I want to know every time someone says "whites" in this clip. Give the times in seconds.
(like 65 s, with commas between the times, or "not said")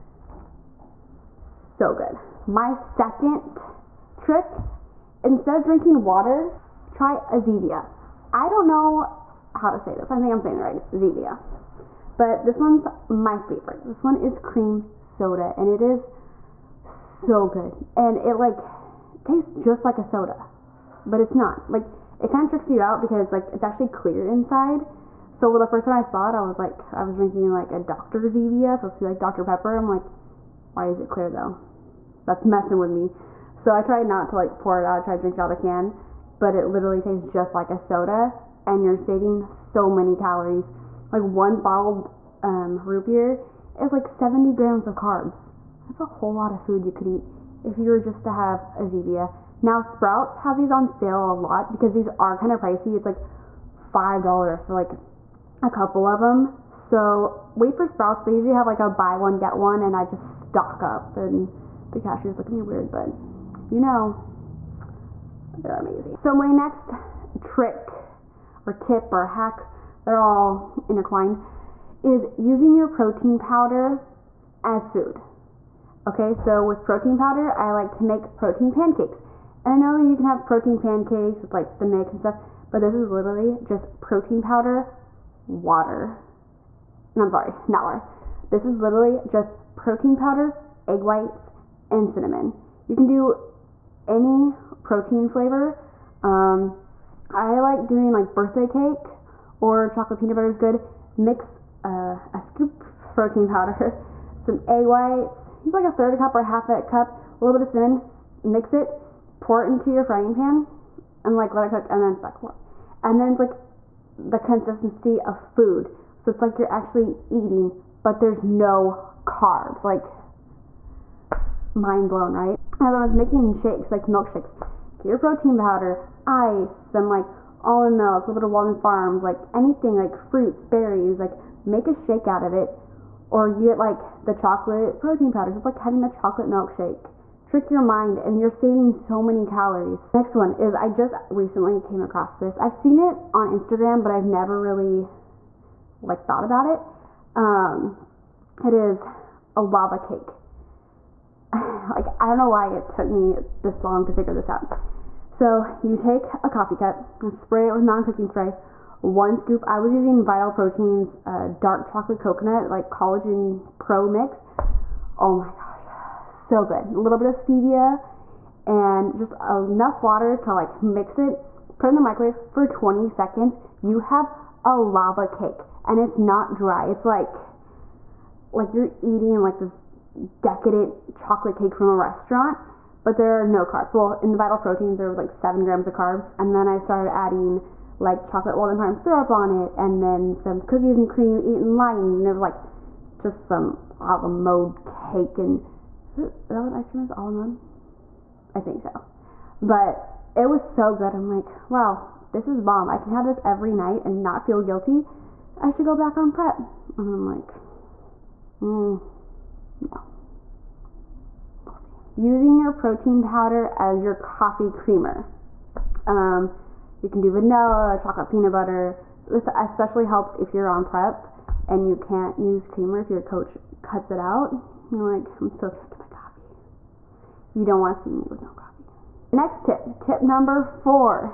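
91 s, 104 s.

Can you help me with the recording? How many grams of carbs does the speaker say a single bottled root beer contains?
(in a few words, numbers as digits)
70.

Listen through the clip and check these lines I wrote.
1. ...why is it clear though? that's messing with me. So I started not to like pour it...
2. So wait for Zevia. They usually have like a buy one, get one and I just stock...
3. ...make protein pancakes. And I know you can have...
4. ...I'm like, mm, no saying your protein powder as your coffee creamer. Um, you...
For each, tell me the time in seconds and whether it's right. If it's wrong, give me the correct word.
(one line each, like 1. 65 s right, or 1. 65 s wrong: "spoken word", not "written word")
1. 30 s wrong: "tried", not "started"
2. 56 s wrong: "Sprouts", not "Zevia"
3. 78 s right
4. 207 s wrong: "using", not "saying".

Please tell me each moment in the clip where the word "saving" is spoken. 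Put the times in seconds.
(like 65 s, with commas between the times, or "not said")
38 s, 138 s.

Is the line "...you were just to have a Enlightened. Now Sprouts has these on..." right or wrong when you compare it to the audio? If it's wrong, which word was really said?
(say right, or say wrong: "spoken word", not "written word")
wrong: "Zevia", not "Enlightened".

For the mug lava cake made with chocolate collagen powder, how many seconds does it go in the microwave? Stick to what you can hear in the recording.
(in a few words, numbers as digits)
20 seconds.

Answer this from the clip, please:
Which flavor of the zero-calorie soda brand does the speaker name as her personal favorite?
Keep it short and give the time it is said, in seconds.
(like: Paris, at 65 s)
cream soda, at 14 s.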